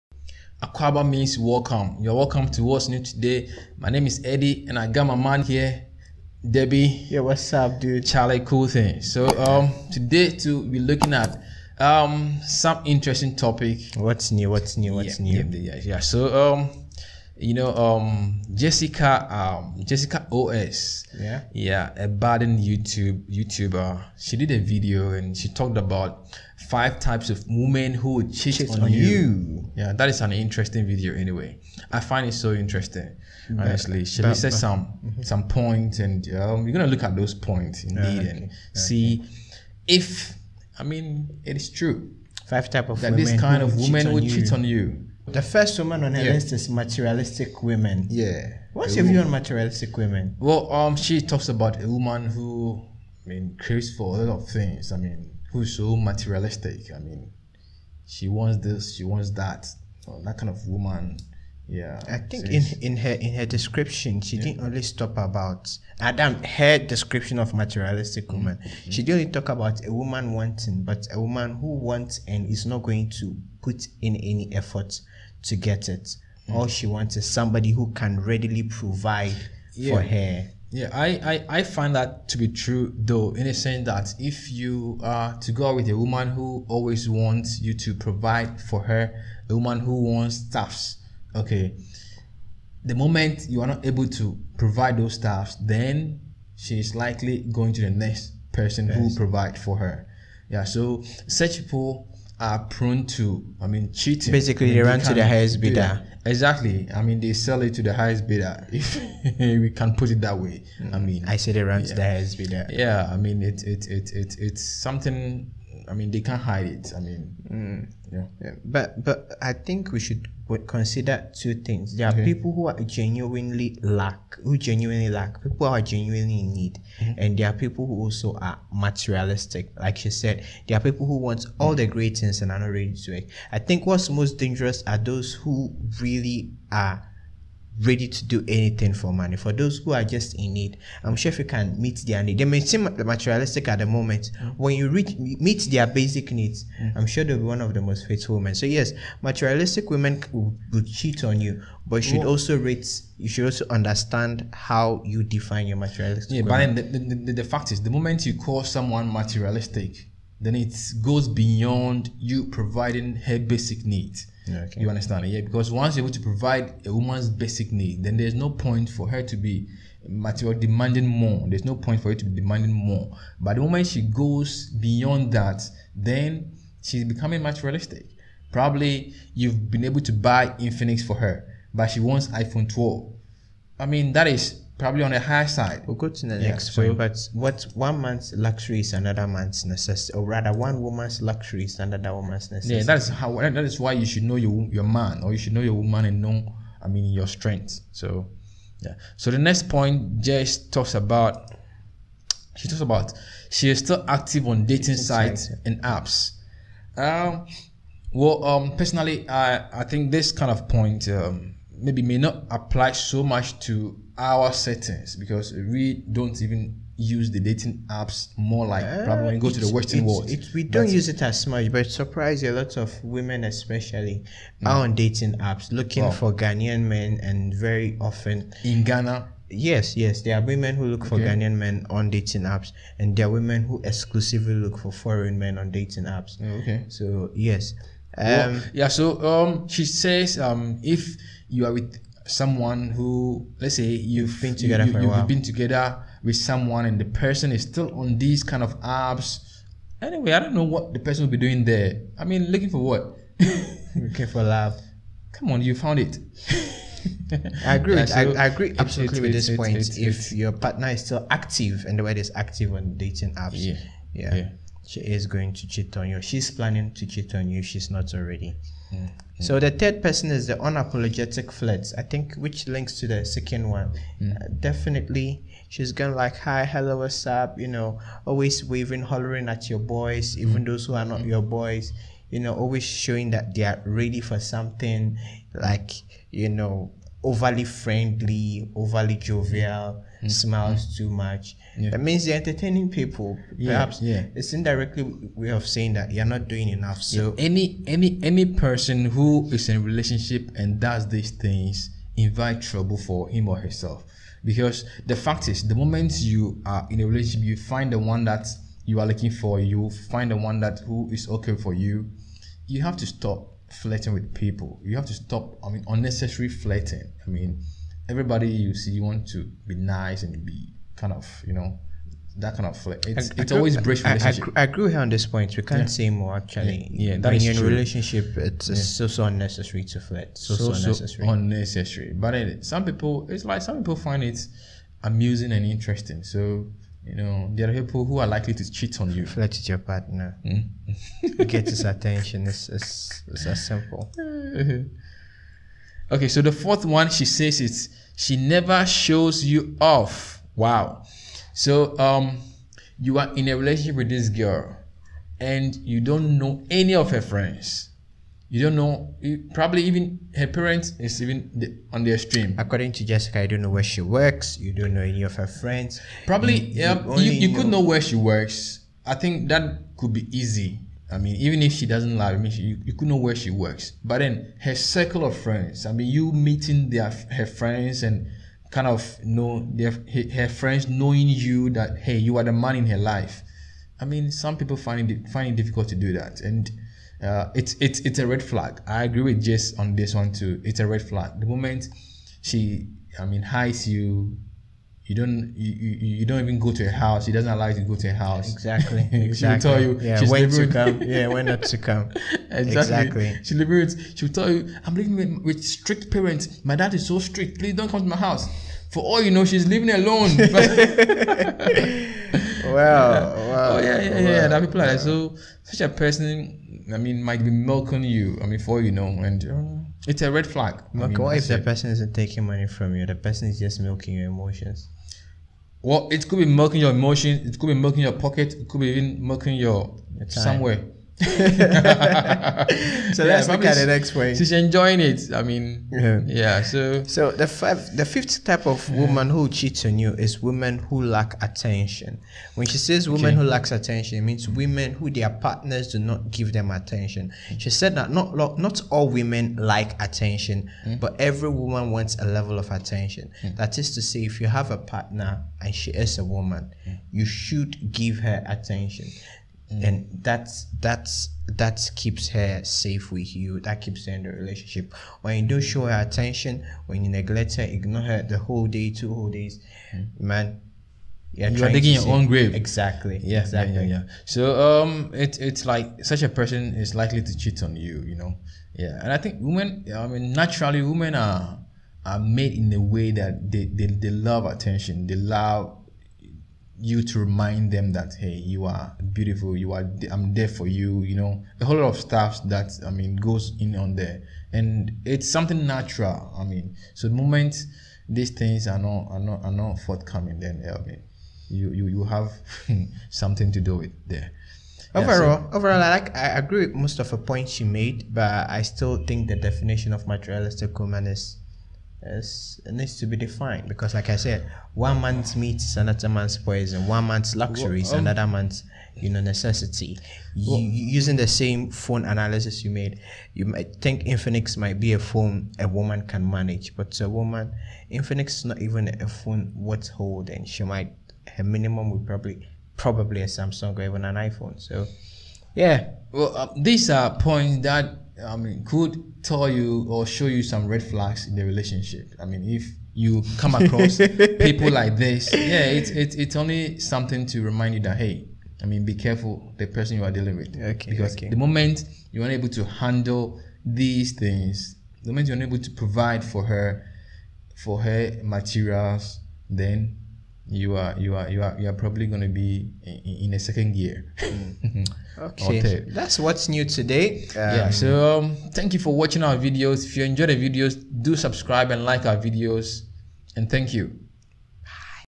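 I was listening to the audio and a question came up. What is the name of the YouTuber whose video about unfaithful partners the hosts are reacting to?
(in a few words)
Jessica OS.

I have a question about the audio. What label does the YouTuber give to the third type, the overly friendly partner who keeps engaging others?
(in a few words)
unapologetic flirts.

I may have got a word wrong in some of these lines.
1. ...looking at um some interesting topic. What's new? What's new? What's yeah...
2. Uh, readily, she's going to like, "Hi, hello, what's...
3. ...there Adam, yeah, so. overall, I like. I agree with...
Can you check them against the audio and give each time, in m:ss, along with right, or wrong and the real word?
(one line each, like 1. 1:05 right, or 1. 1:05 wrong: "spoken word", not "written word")
1. 0:10 right
2. 4:34 wrong: "definitely", not "readily"
3. 8:24 wrong: "Overall", not "Adam".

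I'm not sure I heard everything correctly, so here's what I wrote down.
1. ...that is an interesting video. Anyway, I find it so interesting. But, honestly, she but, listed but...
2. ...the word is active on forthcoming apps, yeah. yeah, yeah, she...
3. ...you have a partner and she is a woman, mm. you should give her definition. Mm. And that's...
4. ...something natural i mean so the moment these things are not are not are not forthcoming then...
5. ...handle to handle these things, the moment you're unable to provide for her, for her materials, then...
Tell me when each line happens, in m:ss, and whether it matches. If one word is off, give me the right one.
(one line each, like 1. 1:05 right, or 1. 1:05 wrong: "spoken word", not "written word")
1. 0:29 right
2. 4:21 wrong: "dating", not "forthcoming"
3. 7:34 wrong: "attention", not "definition"
4. 8:15 right
5. 9:12 wrong: "unable", not "handle".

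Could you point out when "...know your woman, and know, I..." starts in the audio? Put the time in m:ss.
3:15.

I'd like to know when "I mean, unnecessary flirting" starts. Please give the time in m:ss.
5:15.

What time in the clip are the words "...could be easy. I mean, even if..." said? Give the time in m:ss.
6:09.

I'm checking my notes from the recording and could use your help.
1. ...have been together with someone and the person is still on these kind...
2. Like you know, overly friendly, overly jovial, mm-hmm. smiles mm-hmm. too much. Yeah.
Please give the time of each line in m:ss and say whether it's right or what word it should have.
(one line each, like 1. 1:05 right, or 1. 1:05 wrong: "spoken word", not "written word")
1. 4:05 right
2. 4:45 right.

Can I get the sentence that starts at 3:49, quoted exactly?
Yes, yes, there are women who look okay.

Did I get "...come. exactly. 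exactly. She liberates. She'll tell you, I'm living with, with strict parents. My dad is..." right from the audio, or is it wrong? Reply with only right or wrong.
right.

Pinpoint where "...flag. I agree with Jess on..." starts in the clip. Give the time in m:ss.
6:28.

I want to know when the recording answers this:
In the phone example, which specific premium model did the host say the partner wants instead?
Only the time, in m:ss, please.
3:02.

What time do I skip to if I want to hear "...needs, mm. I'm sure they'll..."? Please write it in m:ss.
2:26.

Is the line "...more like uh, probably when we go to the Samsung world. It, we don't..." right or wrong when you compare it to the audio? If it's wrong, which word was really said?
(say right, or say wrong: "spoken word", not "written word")
wrong: "Western", not "Samsung".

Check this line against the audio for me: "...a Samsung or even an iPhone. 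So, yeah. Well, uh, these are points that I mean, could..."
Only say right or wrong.
right.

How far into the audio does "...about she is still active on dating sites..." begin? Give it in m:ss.
3:22.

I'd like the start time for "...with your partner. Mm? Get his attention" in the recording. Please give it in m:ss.
5:39.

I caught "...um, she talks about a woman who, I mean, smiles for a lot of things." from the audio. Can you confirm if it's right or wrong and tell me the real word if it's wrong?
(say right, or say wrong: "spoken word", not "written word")
wrong: "craves", not "smiles".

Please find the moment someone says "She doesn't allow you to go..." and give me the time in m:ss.
6:37.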